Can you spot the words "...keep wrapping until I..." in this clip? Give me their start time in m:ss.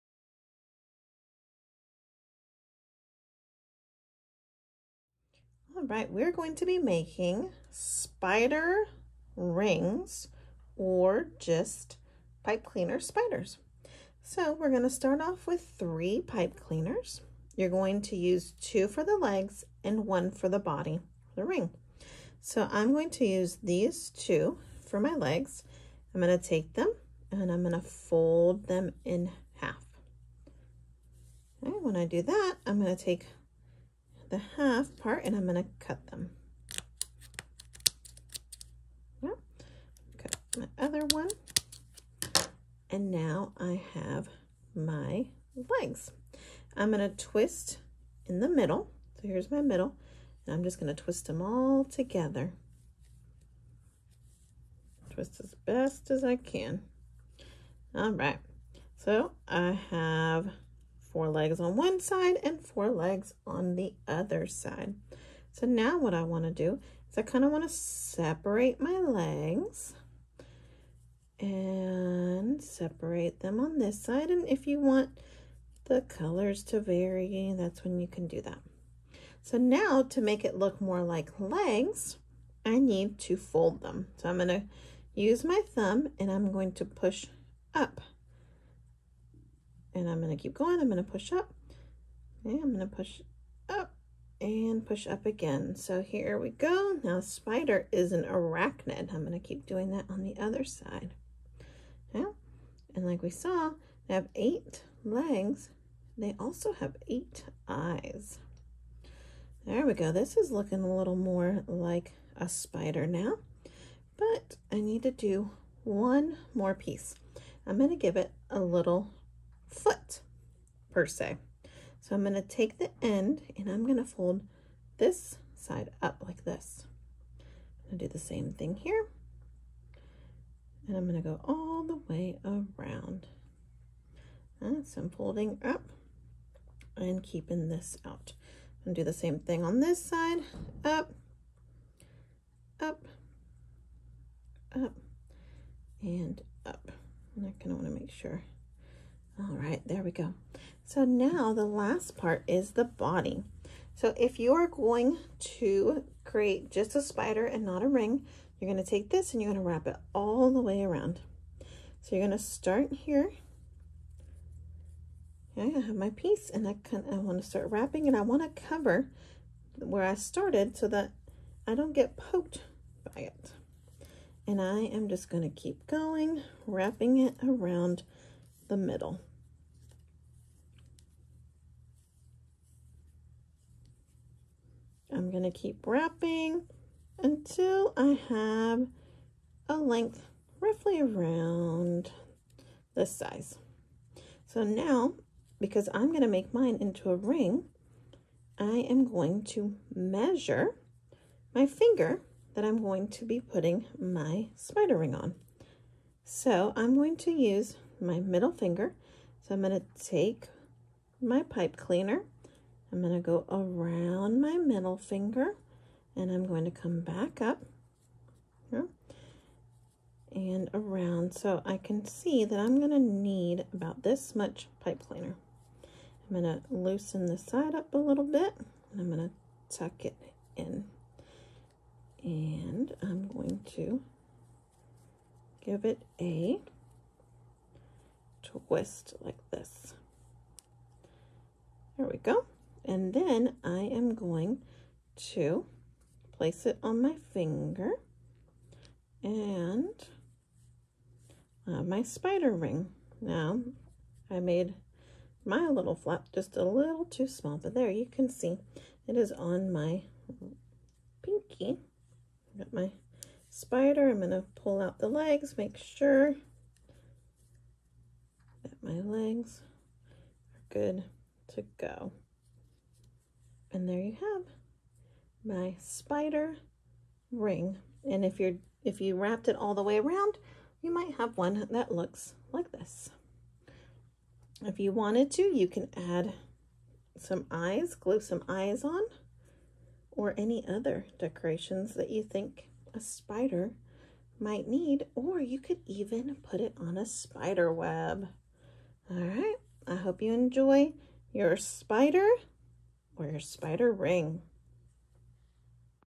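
3:05.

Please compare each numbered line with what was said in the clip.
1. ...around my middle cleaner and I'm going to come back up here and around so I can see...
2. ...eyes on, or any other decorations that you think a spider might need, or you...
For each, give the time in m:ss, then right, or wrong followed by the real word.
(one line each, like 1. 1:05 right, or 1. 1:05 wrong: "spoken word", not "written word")
1. 3:33 wrong: "finger", not "cleaner"
2. 4:48 right.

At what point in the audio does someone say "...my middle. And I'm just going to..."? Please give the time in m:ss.
0:49.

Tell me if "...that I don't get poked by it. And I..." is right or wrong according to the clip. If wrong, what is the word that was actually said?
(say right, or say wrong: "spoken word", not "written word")
right.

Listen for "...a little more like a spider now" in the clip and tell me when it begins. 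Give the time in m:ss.
1:50.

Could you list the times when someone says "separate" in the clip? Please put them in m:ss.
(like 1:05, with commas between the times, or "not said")
1:07, 1:12.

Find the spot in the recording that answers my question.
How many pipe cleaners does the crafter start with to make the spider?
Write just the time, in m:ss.
0:15.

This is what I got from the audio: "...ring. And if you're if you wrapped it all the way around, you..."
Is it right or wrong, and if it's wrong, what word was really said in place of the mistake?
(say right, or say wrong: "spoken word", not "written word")
right.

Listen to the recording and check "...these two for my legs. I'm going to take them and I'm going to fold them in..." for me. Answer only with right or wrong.
right.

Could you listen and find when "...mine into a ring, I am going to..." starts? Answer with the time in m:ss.
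3:16.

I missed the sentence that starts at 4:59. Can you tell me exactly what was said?
All right, I hope you enjoy your spider or your spider ring.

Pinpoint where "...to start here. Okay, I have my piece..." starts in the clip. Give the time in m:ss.
2:42.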